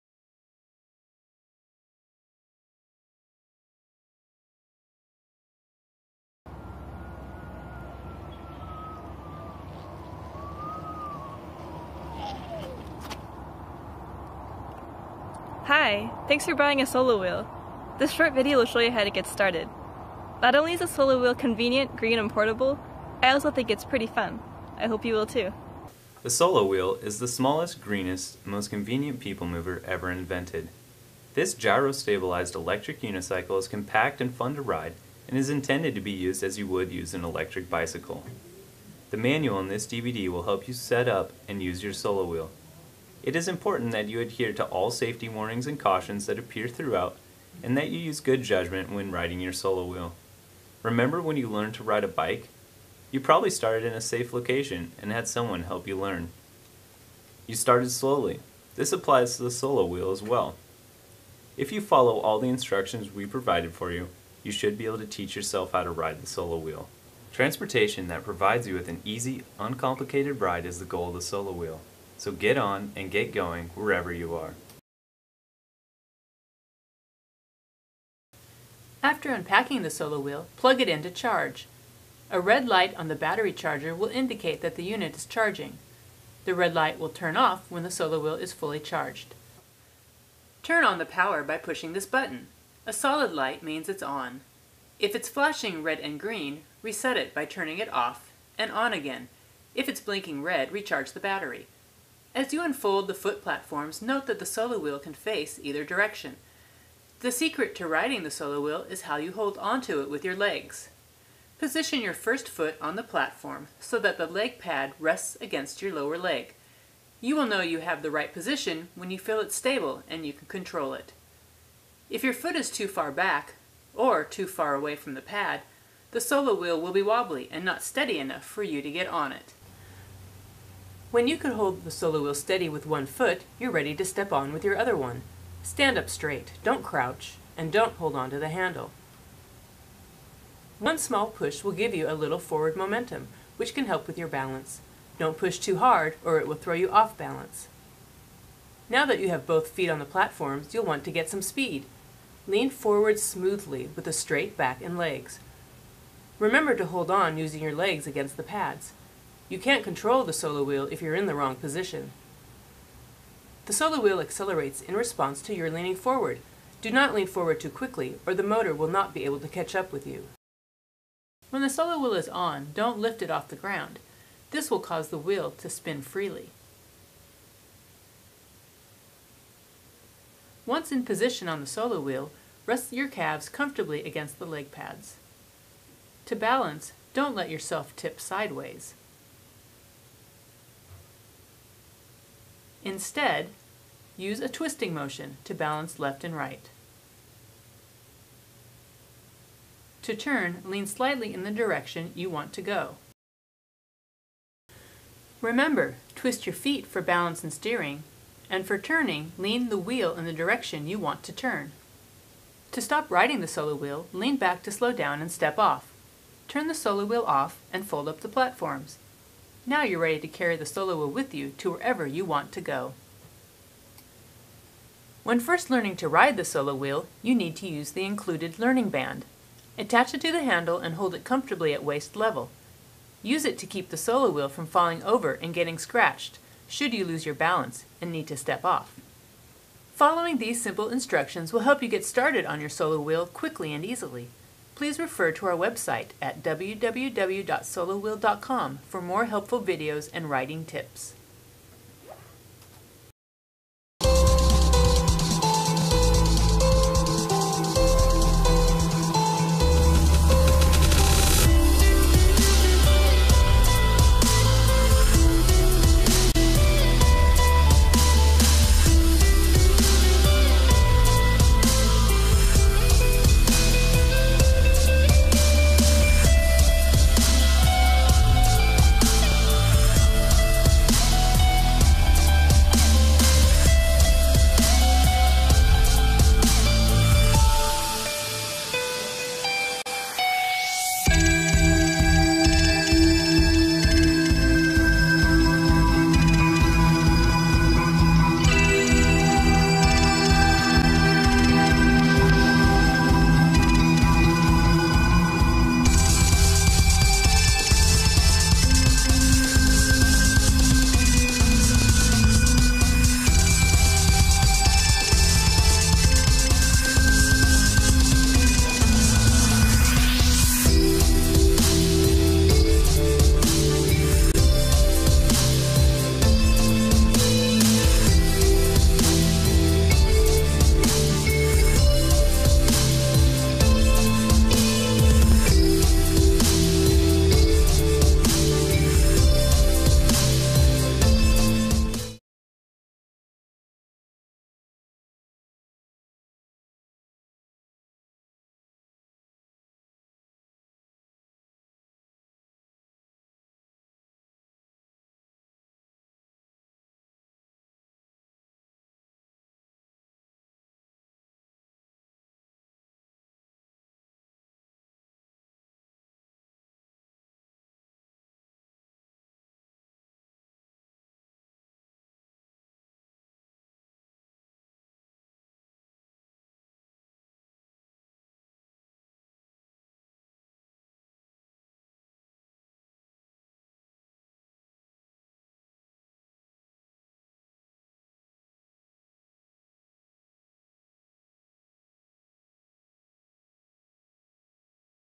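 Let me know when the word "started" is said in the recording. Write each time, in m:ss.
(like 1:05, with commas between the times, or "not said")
0:19, 0:53, 0:57, 4:02.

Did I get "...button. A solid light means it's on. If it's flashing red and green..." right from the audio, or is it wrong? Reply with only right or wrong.
right.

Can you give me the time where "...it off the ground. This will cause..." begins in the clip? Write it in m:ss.
2:53.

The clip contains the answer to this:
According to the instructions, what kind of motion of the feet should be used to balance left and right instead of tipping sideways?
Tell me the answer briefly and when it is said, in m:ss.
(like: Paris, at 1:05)
twisting motion, at 3:14.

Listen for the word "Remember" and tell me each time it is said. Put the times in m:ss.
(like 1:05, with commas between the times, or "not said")
0:50, 2:36, 3:25.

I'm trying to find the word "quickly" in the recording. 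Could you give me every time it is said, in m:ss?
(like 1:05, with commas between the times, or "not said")
2:47, 4:03.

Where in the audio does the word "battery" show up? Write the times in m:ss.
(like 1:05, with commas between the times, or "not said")
1:23, 1:41.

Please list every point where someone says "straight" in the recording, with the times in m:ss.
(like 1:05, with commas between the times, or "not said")
2:16, 2:34.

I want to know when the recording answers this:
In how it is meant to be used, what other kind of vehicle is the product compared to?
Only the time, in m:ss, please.
0:37.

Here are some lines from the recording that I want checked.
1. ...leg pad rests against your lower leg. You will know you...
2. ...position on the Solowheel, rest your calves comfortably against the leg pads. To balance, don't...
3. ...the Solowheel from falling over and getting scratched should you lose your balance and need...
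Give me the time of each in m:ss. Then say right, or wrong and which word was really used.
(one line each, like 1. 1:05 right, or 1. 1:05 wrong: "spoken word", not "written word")
1. 1:54 right
2. 3:01 right
3. 3:53 right.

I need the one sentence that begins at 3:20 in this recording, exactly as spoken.
To turn, lean slightly in the direction you want to go.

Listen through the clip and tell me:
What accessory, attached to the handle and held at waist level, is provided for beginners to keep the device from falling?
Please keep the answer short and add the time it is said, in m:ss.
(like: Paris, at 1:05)
learning band, at 3:48.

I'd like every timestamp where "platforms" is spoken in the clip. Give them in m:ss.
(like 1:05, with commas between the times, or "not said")
1:43, 1:53, 2:30, 3:38.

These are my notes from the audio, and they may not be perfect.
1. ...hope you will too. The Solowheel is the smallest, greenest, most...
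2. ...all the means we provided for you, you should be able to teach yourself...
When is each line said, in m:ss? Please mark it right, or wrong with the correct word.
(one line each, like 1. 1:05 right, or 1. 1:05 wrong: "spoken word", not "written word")
1. 0:24 right
2. 1:02 wrong: "instructions", not "means".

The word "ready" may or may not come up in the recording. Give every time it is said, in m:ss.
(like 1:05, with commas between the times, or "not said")
2:13, 3:39.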